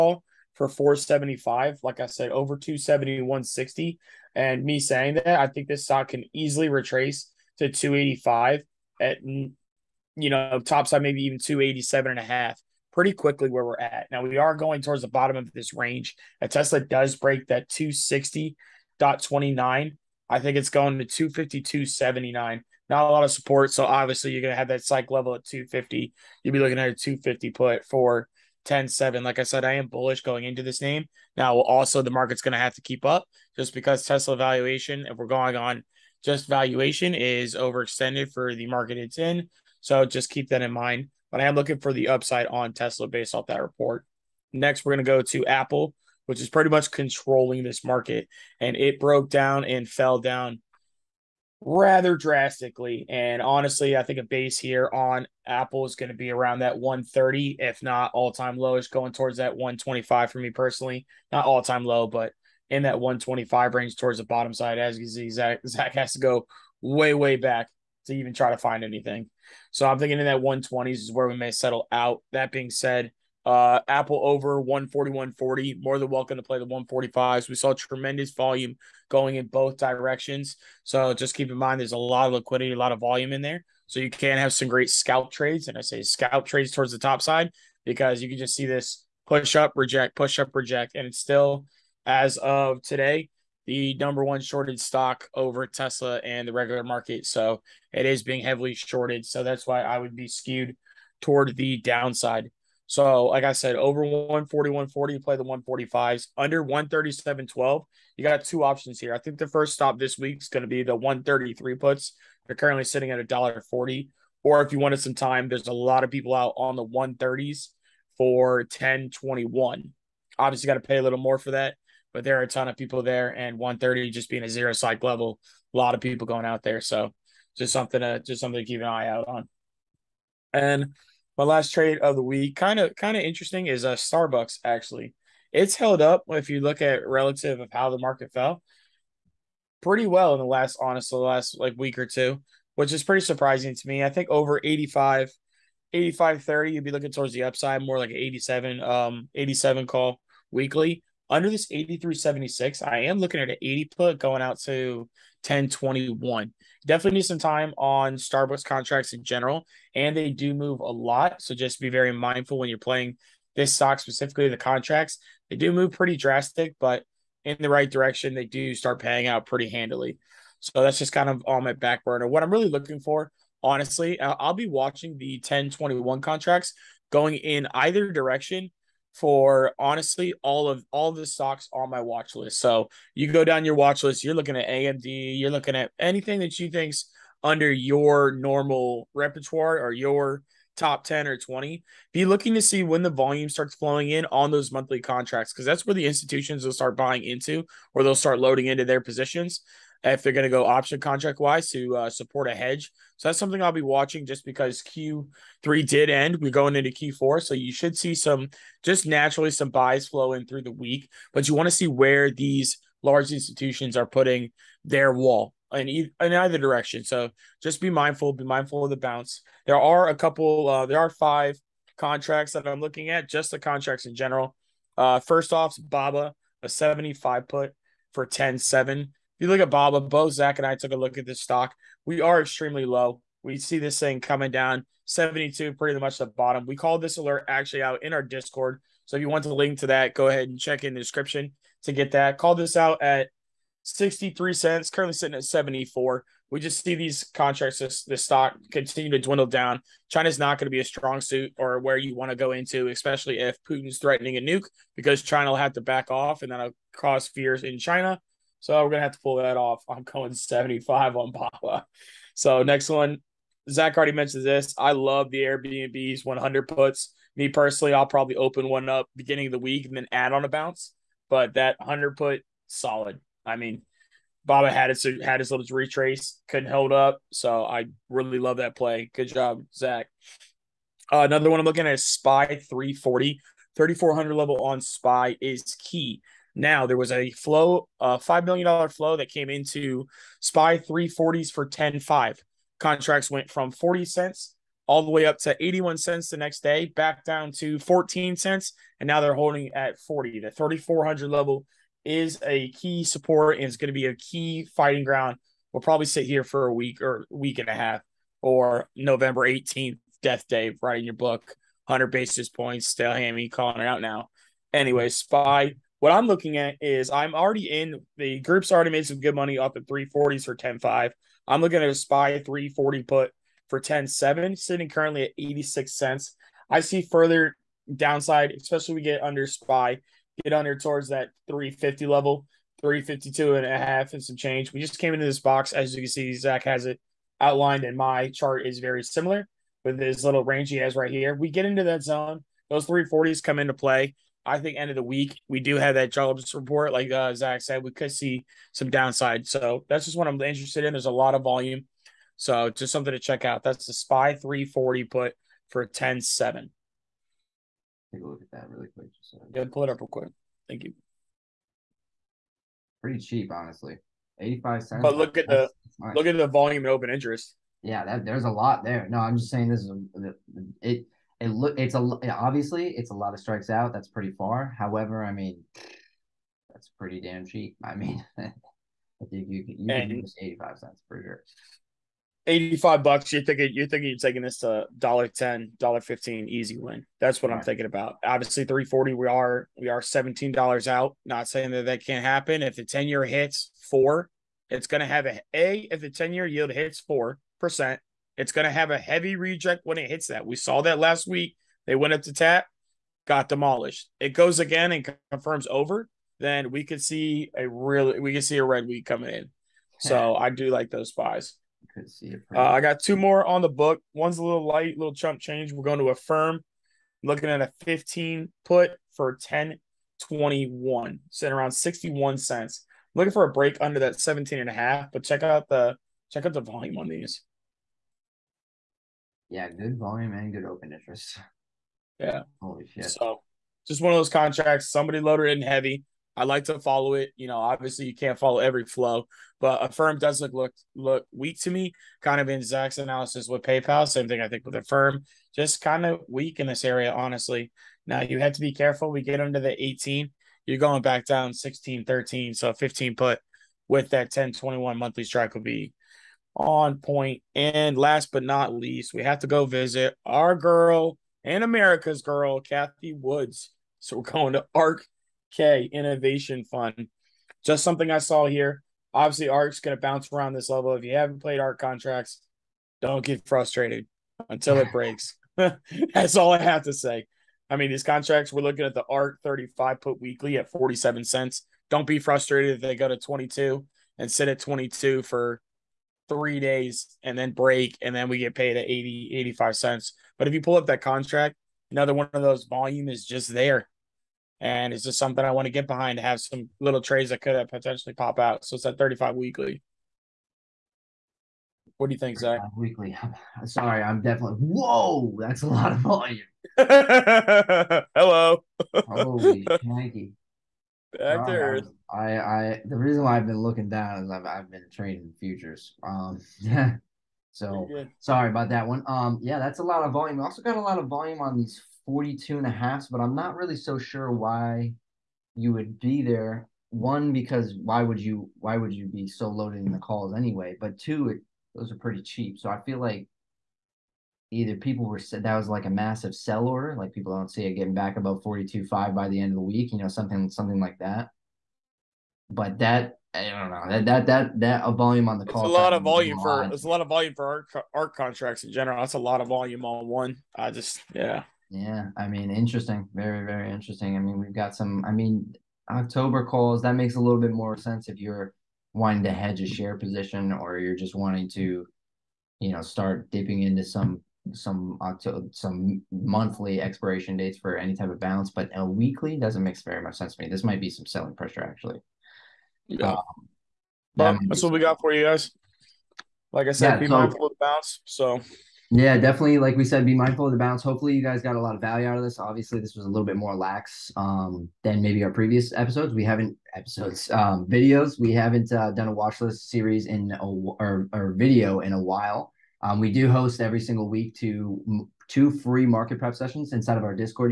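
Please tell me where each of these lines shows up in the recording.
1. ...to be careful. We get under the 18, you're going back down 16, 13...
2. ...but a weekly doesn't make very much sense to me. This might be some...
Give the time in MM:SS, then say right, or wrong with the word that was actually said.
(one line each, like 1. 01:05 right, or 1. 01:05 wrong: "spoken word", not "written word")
1. 07:28 right
2. 09:28 right.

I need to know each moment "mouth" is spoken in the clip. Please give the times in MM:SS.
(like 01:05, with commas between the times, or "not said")
not said.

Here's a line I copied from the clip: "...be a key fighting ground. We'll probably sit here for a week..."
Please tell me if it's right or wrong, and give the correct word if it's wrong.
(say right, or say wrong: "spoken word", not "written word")
right.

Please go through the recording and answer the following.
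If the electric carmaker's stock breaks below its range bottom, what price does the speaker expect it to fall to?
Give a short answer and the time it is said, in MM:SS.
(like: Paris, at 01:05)
252.79, at 00:21.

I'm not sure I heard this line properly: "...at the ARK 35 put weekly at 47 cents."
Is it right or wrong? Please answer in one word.
right.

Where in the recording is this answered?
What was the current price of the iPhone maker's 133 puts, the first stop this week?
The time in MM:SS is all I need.
01:53.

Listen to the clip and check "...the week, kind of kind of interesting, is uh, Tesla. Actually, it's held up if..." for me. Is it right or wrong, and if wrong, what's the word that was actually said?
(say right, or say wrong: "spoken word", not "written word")
wrong: "Starbucks", not "Tesla".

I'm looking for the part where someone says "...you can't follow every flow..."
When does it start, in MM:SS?
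07:18.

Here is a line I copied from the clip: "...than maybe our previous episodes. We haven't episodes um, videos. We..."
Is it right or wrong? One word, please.
right.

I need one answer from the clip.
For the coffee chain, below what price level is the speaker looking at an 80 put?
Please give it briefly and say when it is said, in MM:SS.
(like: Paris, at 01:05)
83.76, at 02:31.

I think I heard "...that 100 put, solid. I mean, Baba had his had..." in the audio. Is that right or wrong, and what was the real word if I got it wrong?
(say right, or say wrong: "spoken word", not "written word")
right.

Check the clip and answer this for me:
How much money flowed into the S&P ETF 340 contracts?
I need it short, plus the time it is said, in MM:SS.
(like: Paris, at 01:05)
5 million dollars, at 04:48.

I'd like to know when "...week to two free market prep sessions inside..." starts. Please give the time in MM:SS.
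09:54.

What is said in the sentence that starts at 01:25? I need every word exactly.
And I say scalp trades towards the top side because you can just see this push up, reject, push up, reject.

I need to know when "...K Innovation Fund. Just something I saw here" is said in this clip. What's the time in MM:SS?
07:45.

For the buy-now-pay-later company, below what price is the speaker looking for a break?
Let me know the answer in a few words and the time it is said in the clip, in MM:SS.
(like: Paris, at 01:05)
17.5, at 07:04.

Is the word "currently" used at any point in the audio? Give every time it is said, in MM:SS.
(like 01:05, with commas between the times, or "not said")
01:52, 04:04, 05:24.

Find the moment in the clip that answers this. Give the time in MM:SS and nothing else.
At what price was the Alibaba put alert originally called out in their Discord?
04:03.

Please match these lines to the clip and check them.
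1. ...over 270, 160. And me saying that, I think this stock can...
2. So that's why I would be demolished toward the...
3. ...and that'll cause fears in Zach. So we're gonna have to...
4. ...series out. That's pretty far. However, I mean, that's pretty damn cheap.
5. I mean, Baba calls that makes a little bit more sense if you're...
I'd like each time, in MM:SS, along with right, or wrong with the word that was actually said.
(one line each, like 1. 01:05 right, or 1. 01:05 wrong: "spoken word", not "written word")
1. 00:02 right
2. 01:39 wrong: "skewed", not "demolished"
3. 04:16 wrong: "China", not "Zach"
4. 06:13 wrong: "strikes", not "series"
5. 09:15 wrong: "October", not "Baba".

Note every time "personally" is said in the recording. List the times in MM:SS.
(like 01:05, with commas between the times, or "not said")
01:00, 04:27.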